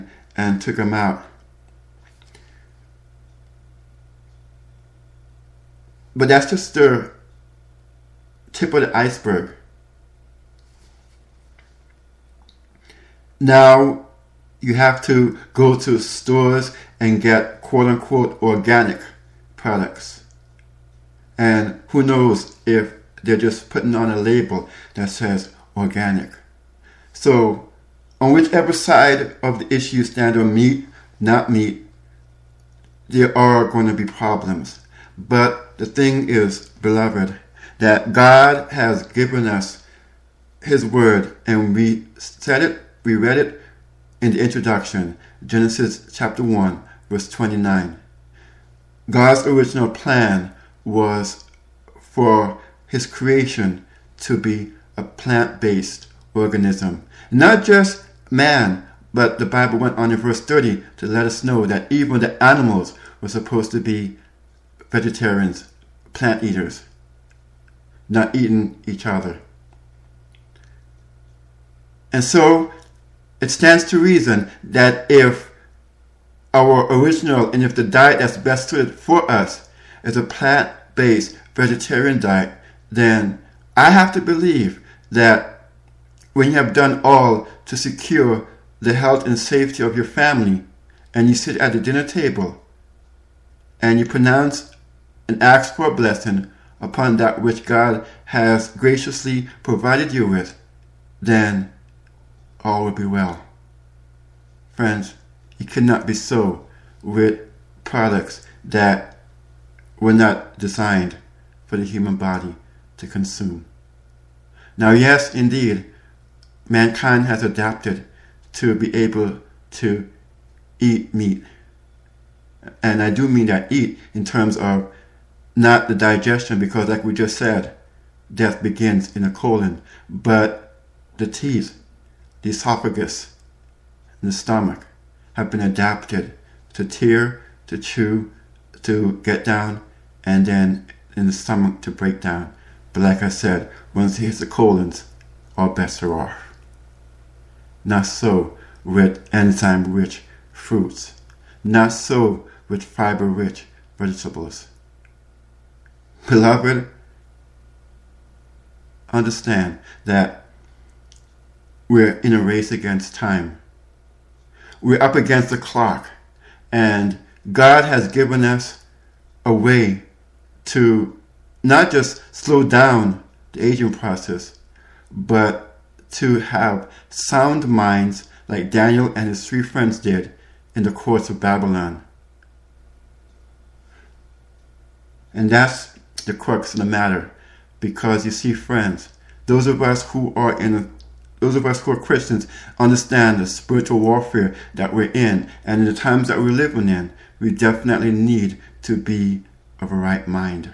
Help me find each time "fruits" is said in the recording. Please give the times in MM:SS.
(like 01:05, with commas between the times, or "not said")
02:30.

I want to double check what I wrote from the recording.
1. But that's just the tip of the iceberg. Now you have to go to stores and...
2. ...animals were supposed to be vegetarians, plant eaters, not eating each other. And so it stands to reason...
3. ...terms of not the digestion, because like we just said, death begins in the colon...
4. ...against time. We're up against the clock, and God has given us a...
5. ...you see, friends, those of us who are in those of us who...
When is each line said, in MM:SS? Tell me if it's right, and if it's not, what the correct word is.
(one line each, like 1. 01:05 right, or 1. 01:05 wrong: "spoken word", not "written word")
1. 00:06 right
2. 01:02 right
3. 02:04 right
4. 02:42 right
5. 03:08 right.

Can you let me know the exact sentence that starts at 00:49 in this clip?
God's original plan was for His creation to be a plant based organism, not just man.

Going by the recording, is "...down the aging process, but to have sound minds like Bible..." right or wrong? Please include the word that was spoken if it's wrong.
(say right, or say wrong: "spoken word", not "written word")
wrong: "Daniel", not "Bible".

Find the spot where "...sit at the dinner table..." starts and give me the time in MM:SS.
01:31.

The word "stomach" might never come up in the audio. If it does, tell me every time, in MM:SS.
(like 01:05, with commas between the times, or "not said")
02:14, 02:21.